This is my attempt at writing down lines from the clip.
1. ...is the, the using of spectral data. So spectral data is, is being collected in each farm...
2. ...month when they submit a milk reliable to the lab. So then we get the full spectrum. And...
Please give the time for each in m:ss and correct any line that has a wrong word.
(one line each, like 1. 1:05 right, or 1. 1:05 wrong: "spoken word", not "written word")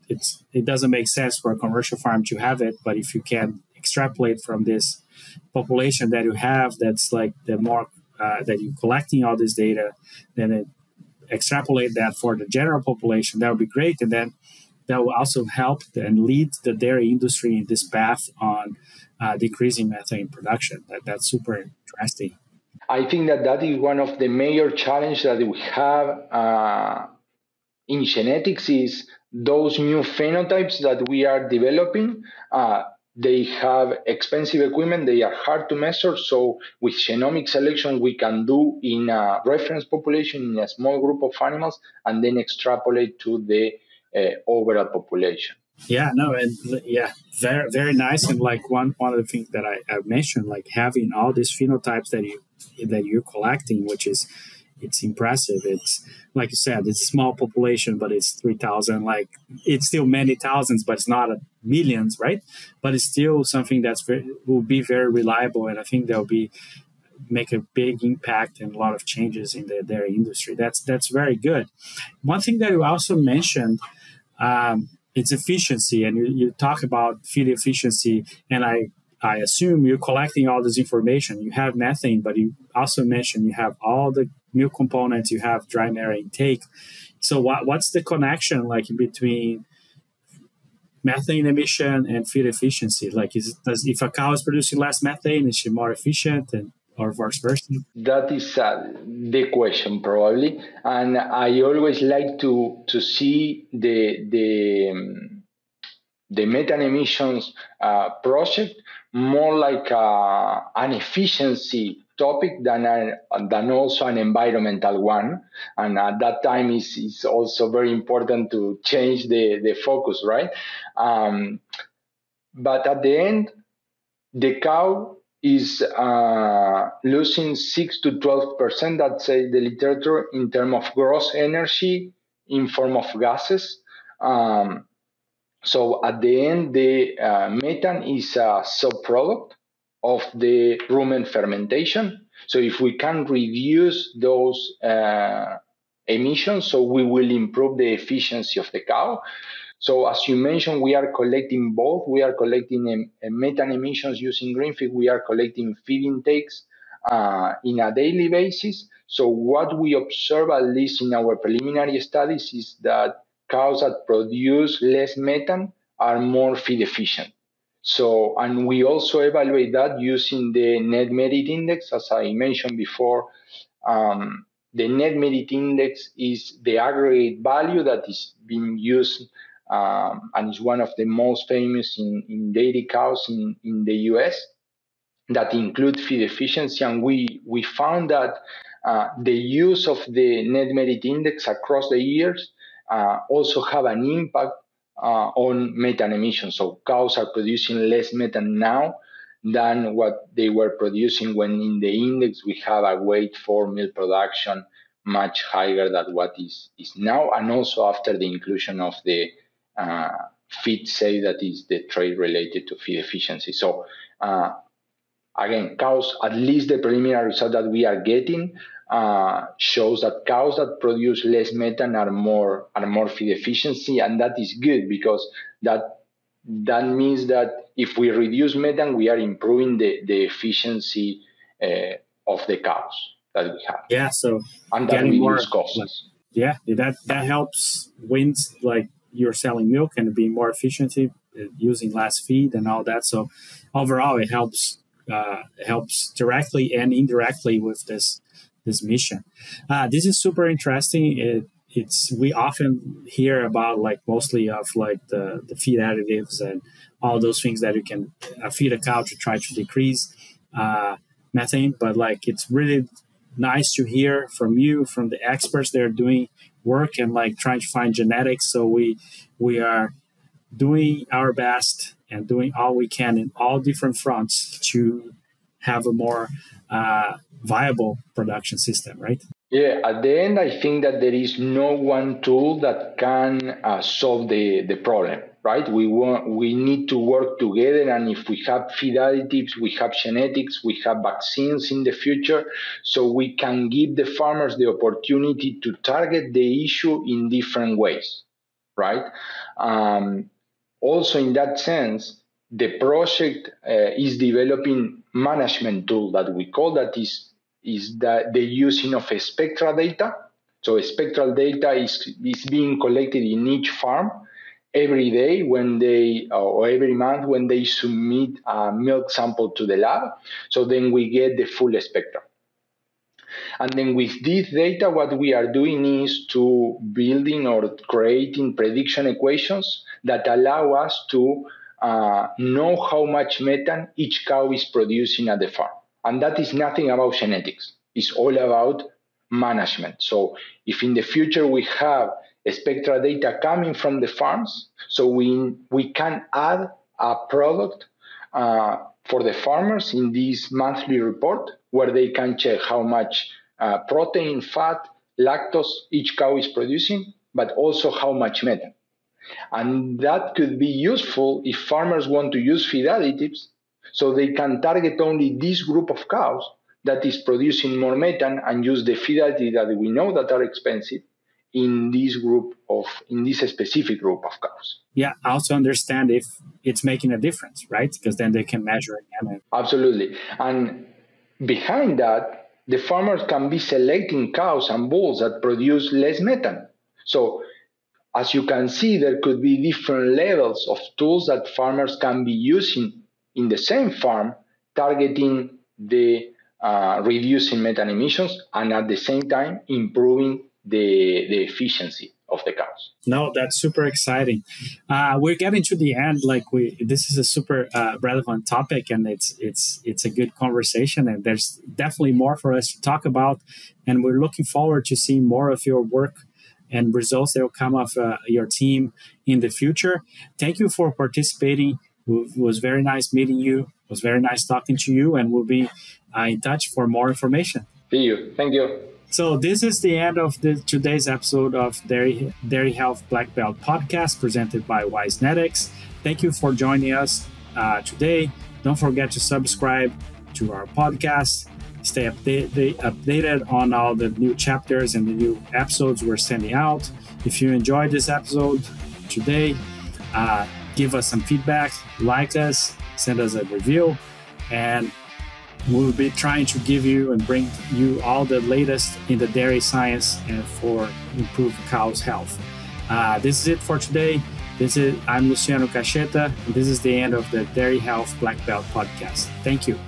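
1. 5:07 right
2. 5:16 wrong: "sample", not "reliable".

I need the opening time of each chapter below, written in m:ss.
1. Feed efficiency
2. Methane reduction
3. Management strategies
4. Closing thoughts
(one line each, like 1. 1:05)
1. 0:54
2. 2:21
3. 4:19
4. 6:37.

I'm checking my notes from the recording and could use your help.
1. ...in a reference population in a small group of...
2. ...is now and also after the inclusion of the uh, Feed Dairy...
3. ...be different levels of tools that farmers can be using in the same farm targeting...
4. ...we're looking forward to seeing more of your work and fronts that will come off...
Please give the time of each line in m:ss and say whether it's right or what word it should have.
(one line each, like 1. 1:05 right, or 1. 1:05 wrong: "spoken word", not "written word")
1. 0:38 right
2. 3:26 wrong: "Saved", not "Dairy"
3. 6:29 right
4. 6:54 wrong: "results", not "fronts".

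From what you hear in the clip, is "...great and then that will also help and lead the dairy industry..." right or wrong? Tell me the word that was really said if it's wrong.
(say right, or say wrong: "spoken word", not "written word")
right.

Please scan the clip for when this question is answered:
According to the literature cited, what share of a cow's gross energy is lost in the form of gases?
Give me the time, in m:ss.
2:07.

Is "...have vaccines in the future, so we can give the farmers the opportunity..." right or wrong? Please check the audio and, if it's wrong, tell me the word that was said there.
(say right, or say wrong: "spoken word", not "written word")
right.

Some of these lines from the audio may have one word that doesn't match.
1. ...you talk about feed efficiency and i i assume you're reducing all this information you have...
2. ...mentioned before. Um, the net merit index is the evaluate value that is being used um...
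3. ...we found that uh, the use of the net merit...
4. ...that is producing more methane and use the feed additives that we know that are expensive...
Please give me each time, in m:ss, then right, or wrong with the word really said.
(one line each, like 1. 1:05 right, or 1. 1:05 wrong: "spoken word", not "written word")
1. 1:16 wrong: "collecting", not "reducing"
2. 2:52 wrong: "aggregate", not "evaluate"
3. 3:07 right
4. 6:06 right.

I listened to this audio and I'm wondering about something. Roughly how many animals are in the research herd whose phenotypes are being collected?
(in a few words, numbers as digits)
3000.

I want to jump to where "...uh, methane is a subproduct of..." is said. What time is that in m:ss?
2:17.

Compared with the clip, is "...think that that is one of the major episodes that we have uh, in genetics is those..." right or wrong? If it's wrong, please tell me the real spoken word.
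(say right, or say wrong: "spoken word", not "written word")
wrong: "challenges", not "episodes".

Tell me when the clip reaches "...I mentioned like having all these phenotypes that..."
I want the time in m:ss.
0:49.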